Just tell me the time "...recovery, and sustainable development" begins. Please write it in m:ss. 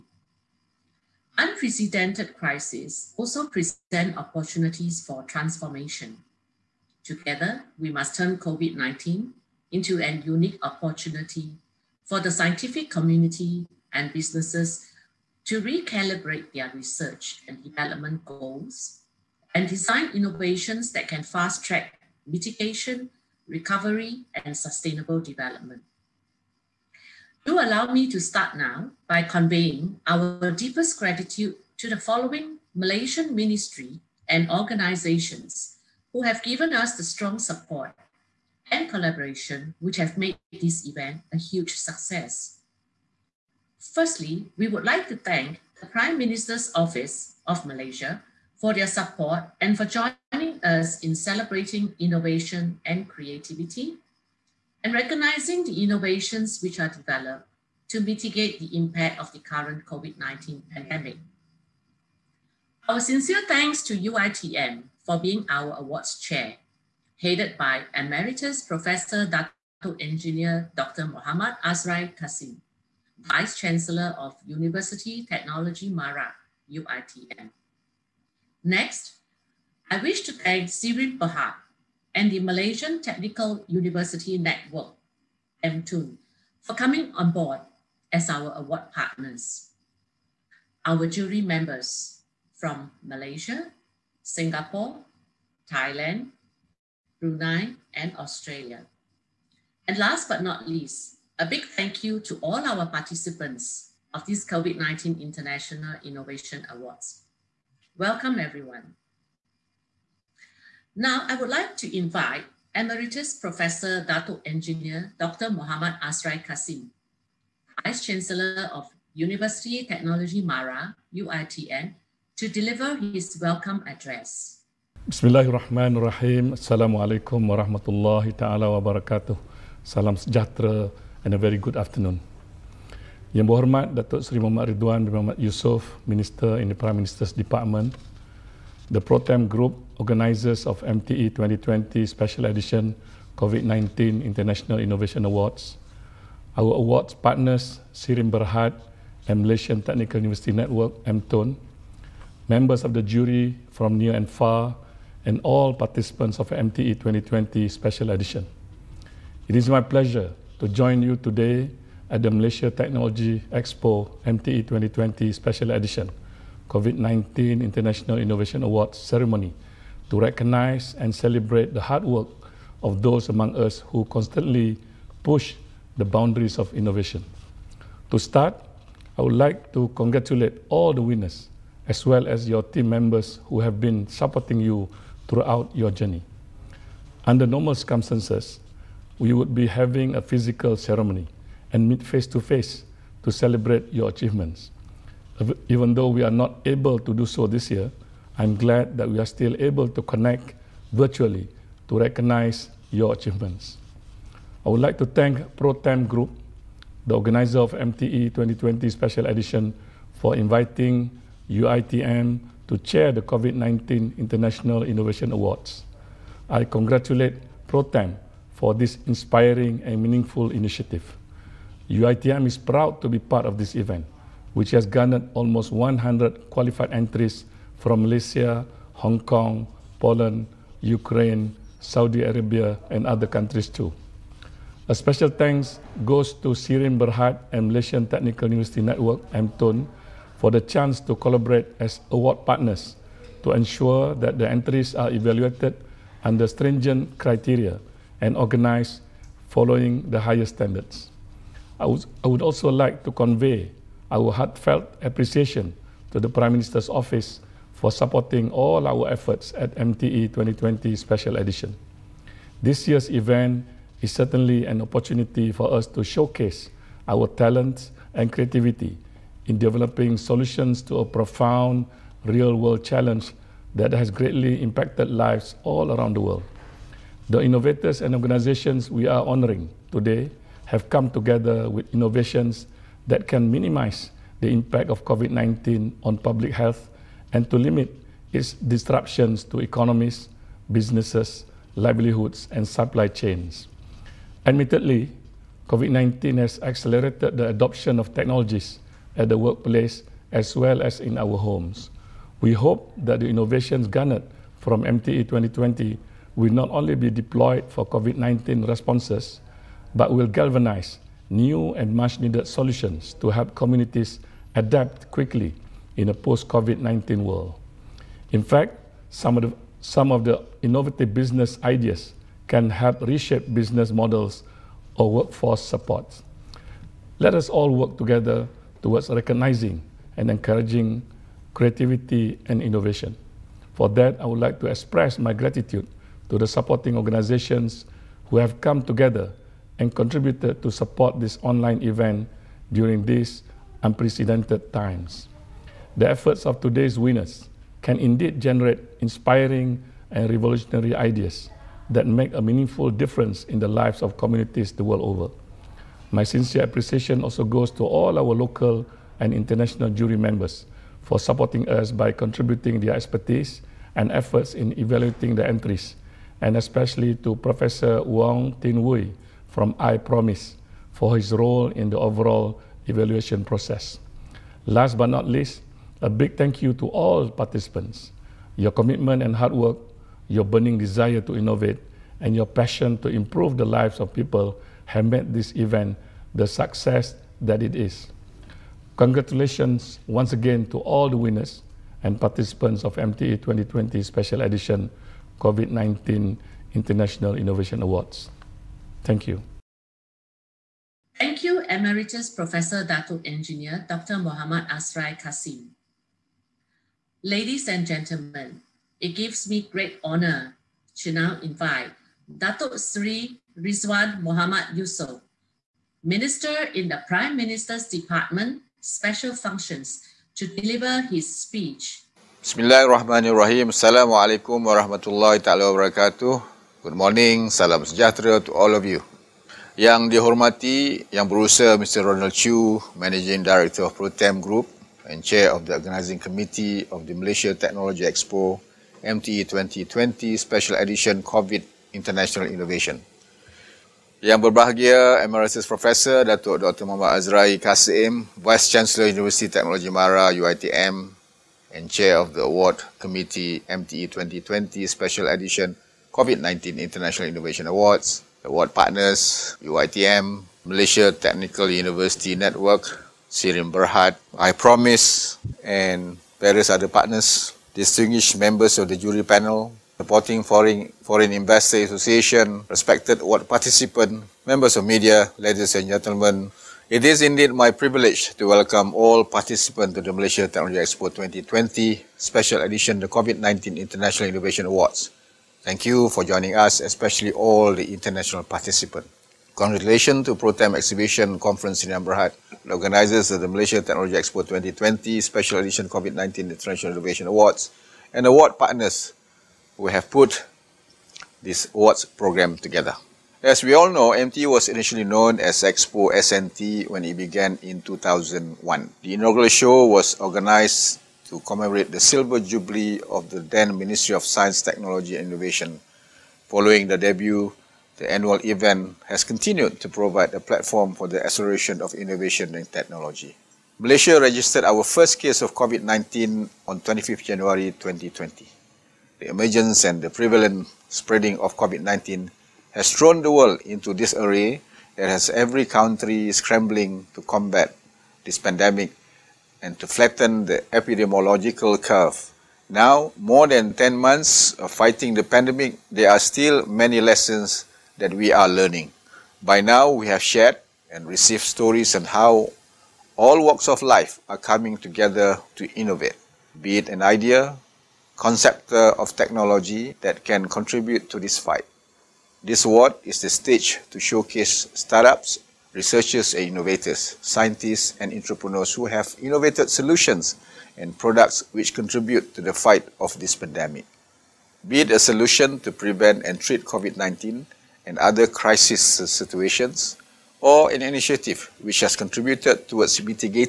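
0:23.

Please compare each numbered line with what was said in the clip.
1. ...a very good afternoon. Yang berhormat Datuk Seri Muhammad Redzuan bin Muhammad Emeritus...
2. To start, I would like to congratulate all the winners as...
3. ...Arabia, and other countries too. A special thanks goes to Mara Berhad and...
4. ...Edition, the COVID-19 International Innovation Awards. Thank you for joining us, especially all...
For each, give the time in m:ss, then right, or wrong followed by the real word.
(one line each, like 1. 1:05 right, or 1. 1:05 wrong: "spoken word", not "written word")
1. 2:11 wrong: "Yusof", not "Emeritus"
2. 2:58 right
3. 3:52 wrong: "Sirim", not "Mara"
4. 8:02 right.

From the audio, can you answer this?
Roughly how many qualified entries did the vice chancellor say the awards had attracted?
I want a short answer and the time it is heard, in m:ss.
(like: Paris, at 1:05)
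almost 100, at 3:45.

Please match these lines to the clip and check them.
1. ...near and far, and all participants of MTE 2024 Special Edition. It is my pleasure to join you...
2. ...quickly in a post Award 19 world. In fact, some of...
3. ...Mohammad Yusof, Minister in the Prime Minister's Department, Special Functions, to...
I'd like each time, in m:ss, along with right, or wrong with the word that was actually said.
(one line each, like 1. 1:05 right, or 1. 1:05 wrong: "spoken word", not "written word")
1. 2:33 wrong: "2020", not "2024"
2. 5:15 wrong: "COVID", not "Award"
3. 6:54 right.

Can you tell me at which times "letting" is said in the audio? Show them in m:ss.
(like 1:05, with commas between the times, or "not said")
not said.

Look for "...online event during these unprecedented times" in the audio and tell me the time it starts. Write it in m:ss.
5:41.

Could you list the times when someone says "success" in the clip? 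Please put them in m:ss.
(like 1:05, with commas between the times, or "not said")
0:41, 6:26.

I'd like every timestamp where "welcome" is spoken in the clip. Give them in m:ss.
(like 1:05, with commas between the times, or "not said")
1:47, 2:03, 7:58.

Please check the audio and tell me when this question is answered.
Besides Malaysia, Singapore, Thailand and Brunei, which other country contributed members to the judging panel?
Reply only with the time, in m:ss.
1:38.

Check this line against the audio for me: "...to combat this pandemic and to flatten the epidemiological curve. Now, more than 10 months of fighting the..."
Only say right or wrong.
right.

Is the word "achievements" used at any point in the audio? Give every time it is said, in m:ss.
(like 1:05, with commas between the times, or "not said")
3:14, 3:23.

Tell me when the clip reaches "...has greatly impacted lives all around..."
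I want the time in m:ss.
4:33.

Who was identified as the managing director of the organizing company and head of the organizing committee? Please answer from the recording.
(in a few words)
Ronald Chu.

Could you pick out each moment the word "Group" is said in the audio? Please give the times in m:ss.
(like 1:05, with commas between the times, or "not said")
2:19, 3:26, 7:14.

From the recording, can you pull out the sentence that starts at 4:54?
Admittedly, COVID-19 has accelerated the adoption of technologies at the workplace as well as in our homes.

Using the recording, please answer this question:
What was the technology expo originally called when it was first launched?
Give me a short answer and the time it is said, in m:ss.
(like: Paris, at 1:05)
Expo S&T, at 8:25.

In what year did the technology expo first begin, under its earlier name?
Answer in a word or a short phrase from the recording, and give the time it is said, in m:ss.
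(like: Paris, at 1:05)
2001, at 8:27.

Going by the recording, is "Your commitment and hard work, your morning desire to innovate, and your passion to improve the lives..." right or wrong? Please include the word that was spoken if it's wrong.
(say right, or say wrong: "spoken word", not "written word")
wrong: "burning", not "morning".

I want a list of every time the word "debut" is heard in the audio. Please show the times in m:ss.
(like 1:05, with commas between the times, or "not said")
8:36.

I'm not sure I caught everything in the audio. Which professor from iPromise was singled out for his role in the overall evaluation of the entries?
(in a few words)
Wong Tin Wui.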